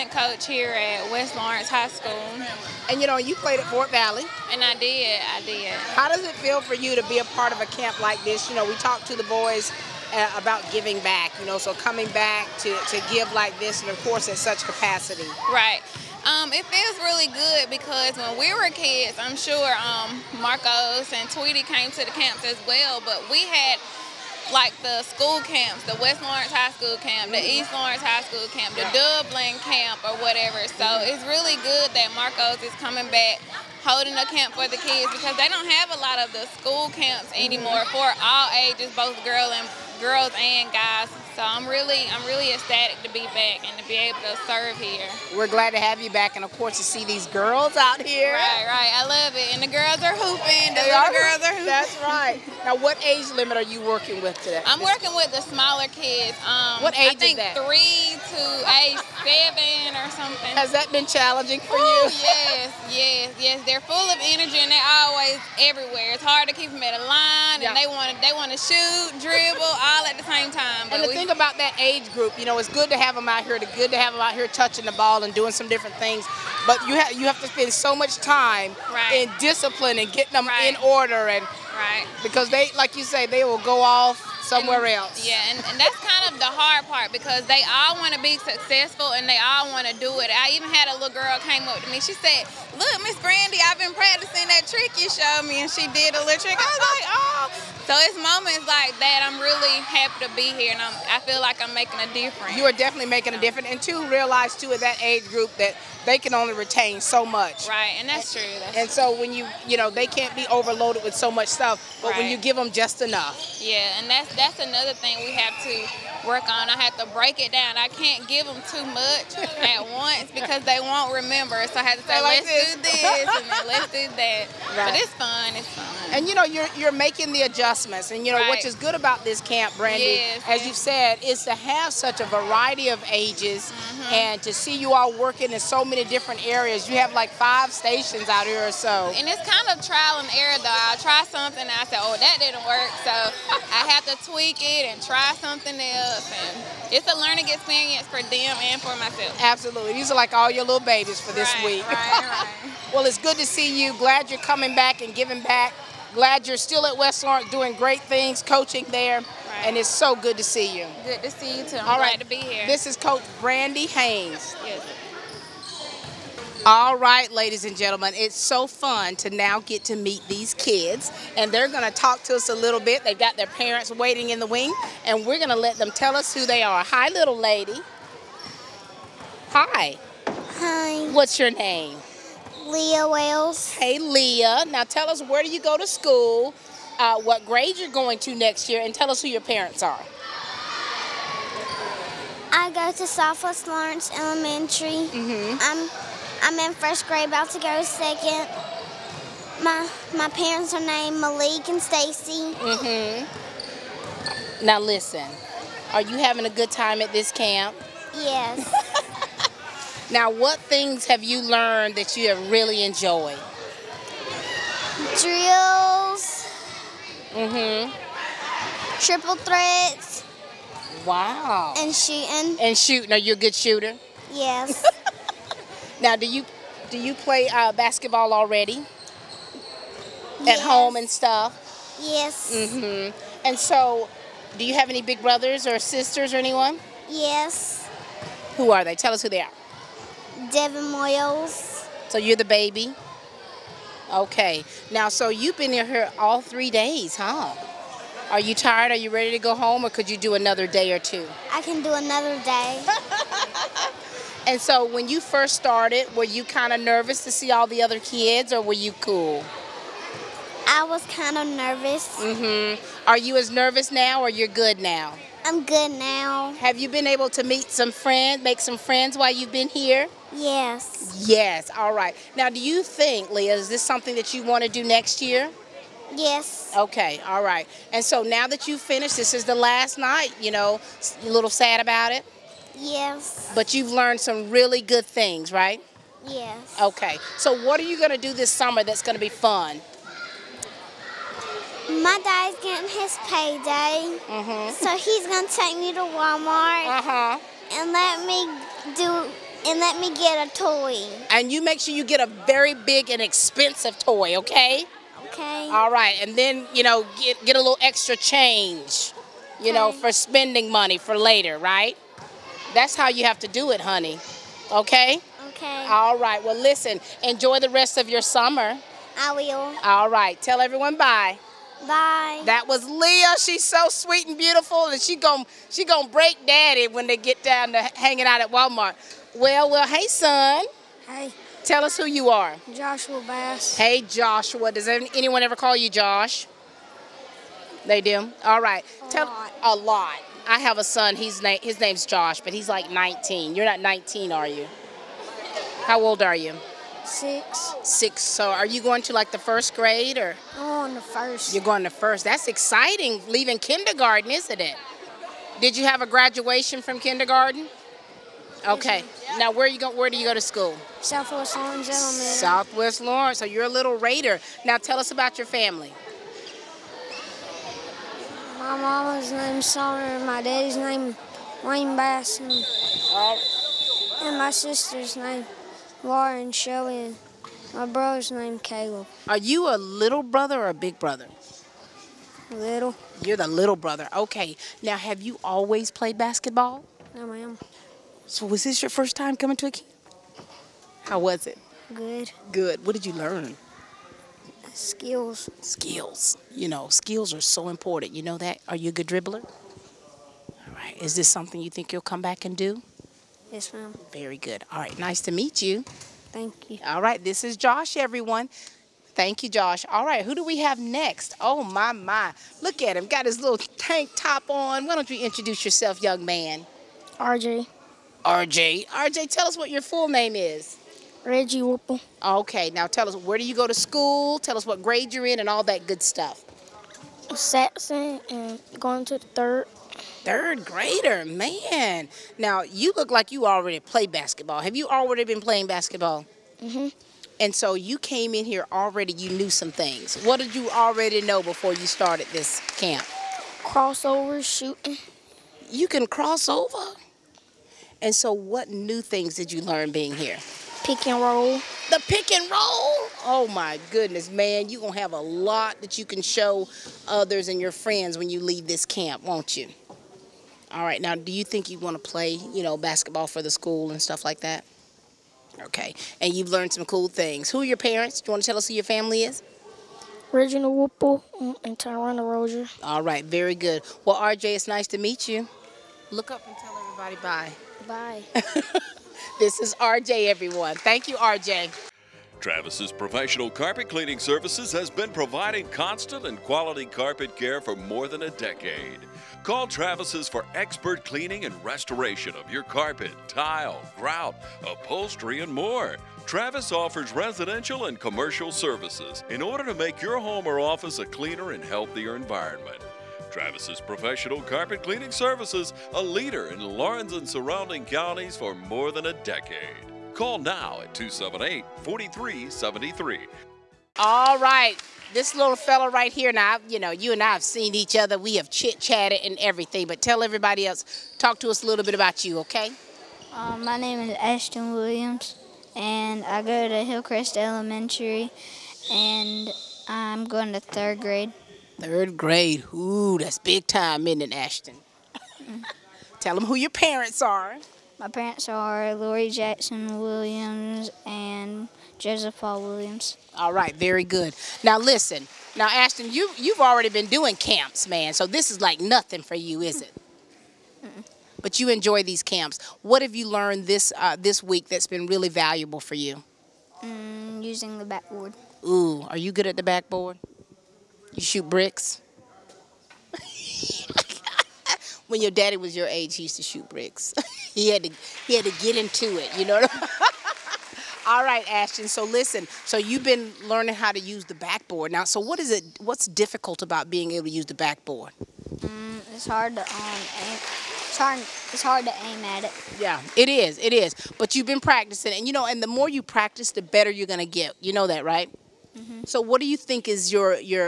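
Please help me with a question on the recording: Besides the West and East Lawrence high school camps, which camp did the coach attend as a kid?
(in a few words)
Dublin camp.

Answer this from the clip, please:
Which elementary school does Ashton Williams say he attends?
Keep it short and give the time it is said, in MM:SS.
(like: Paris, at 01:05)
Hillcrest Elementary, at 08:46.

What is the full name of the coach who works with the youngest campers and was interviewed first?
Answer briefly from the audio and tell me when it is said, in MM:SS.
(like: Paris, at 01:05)
Brandy Haynes, at 02:42.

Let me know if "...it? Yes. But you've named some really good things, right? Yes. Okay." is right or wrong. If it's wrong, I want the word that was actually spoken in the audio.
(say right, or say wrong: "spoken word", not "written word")
wrong: "learned", not "named".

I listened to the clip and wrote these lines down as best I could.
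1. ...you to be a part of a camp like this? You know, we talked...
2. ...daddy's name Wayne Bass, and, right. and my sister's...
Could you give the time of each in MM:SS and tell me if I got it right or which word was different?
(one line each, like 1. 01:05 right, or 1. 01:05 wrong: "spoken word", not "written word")
1. 00:06 right
2. 06:10 right.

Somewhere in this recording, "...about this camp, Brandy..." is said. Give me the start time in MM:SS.
02:08.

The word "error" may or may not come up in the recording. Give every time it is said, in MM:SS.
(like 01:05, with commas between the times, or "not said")
02:20.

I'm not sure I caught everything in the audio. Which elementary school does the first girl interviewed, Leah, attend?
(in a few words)
Southwest Lawrence Elementary.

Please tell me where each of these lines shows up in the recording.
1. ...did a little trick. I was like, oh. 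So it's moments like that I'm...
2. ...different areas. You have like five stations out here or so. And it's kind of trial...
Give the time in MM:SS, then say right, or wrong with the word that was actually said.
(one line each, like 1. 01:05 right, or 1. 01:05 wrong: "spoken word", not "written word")
1. 01:35 right
2. 02:16 right.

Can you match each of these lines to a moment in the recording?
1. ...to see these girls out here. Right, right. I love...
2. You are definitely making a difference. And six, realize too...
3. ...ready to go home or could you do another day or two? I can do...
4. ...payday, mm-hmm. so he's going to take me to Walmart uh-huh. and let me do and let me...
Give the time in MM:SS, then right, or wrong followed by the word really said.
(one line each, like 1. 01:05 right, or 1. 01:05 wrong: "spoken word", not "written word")
1. 00:46 right
2. 01:42 wrong: "two", not "six"
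3. 04:09 right
4. 04:53 right.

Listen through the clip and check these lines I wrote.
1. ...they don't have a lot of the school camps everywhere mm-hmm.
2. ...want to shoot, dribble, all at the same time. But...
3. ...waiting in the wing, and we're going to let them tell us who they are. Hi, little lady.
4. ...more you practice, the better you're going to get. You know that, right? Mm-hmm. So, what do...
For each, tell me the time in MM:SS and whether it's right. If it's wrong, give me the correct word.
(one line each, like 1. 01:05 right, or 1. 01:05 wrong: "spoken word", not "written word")
1. 00:35 wrong: "anymore", not "everywhere"
2. 01:08 right
3. 02:53 right
4. 09:45 right.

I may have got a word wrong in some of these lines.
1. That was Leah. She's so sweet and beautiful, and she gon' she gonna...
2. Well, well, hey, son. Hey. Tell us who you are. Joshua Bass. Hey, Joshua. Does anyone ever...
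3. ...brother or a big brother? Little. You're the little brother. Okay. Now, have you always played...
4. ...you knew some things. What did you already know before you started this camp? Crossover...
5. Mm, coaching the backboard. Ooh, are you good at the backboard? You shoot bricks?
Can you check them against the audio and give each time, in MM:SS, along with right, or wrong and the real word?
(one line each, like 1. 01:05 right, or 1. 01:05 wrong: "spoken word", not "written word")
1. 05:22 right
2. 05:29 right
3. 06:20 right
4. 07:19 right
5. 09:16 wrong: "using", not "coaching".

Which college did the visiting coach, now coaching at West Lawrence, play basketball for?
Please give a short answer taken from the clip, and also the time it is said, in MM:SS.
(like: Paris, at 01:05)
Fort Valley, at 00:03.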